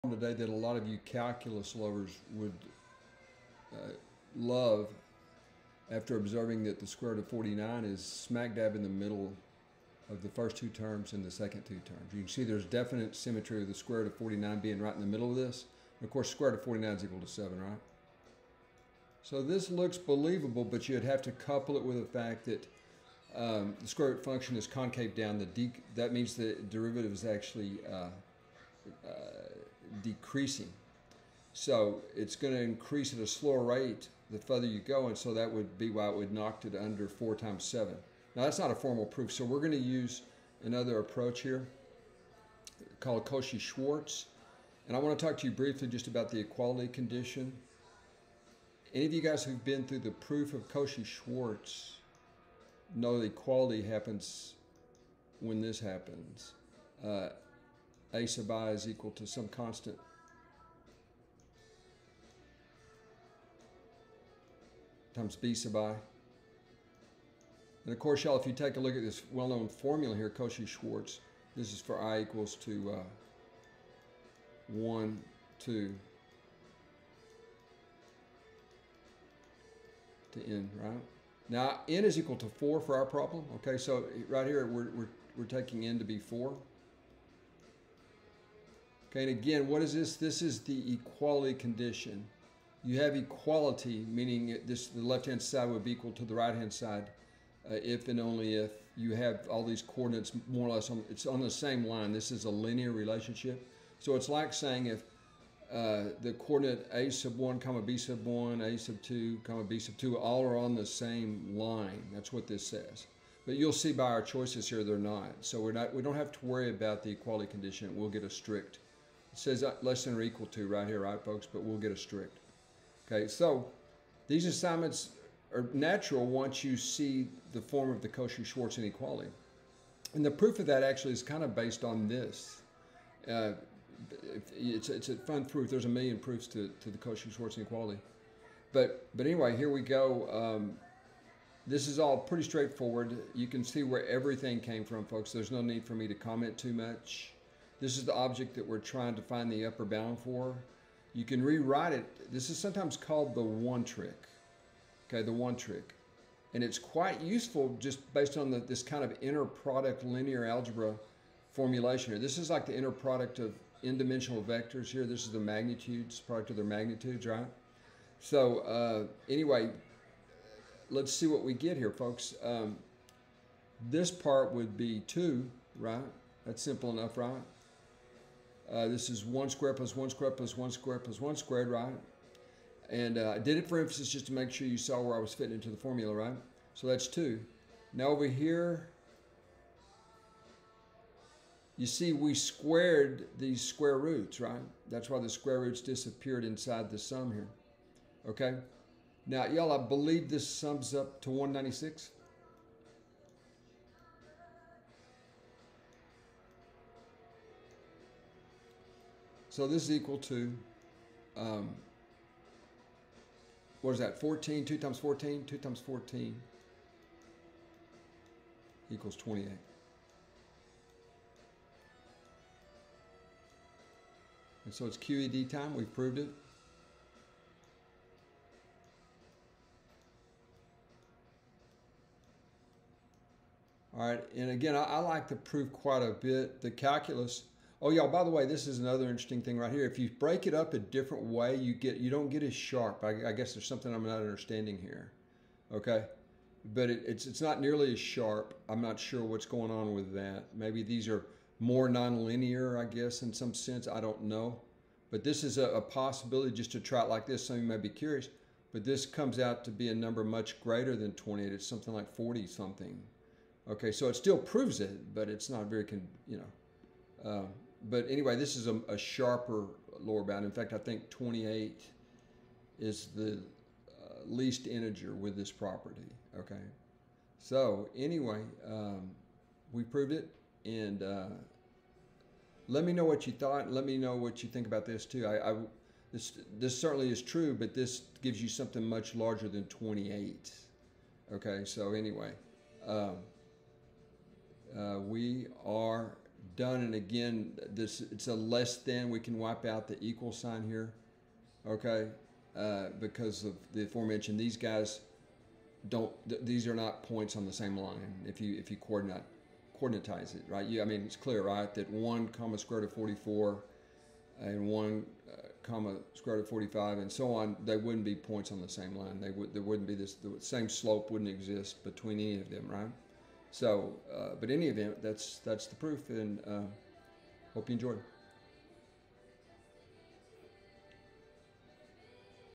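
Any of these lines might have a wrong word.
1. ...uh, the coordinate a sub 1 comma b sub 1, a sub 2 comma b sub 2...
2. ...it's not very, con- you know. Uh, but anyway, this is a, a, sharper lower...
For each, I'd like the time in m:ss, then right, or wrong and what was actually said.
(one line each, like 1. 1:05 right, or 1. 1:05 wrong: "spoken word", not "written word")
1. 1:45 right
2. 4:25 right.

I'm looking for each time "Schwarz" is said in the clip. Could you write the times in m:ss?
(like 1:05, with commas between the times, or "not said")
0:43, 0:50, 1:10, 2:08, 2:16.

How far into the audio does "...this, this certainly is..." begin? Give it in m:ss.
4:46.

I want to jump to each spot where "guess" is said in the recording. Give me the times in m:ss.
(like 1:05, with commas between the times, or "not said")
4:03, 4:12.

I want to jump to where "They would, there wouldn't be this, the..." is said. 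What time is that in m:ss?
5:19.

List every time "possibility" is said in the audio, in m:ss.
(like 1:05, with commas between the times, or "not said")
4:15.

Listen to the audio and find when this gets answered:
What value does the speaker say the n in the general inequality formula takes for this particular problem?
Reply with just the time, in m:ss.
1:21.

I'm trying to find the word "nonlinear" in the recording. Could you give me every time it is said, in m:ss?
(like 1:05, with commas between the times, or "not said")
4:11.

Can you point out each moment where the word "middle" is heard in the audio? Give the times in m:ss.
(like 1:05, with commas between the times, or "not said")
0:08, 0:15.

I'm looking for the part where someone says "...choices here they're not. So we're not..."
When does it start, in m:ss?
1:54.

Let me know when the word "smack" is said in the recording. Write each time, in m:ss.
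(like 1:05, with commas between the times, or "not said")
0:08.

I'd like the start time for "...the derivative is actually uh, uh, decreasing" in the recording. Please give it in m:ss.
0:26.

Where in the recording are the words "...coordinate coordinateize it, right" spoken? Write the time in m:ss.
5:08.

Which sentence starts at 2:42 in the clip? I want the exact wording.
This is like the inner product of n-dimensional vectors here.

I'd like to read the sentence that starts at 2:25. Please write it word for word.
There's no need for me to comment too much.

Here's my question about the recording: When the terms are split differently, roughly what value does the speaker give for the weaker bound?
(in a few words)
40 something.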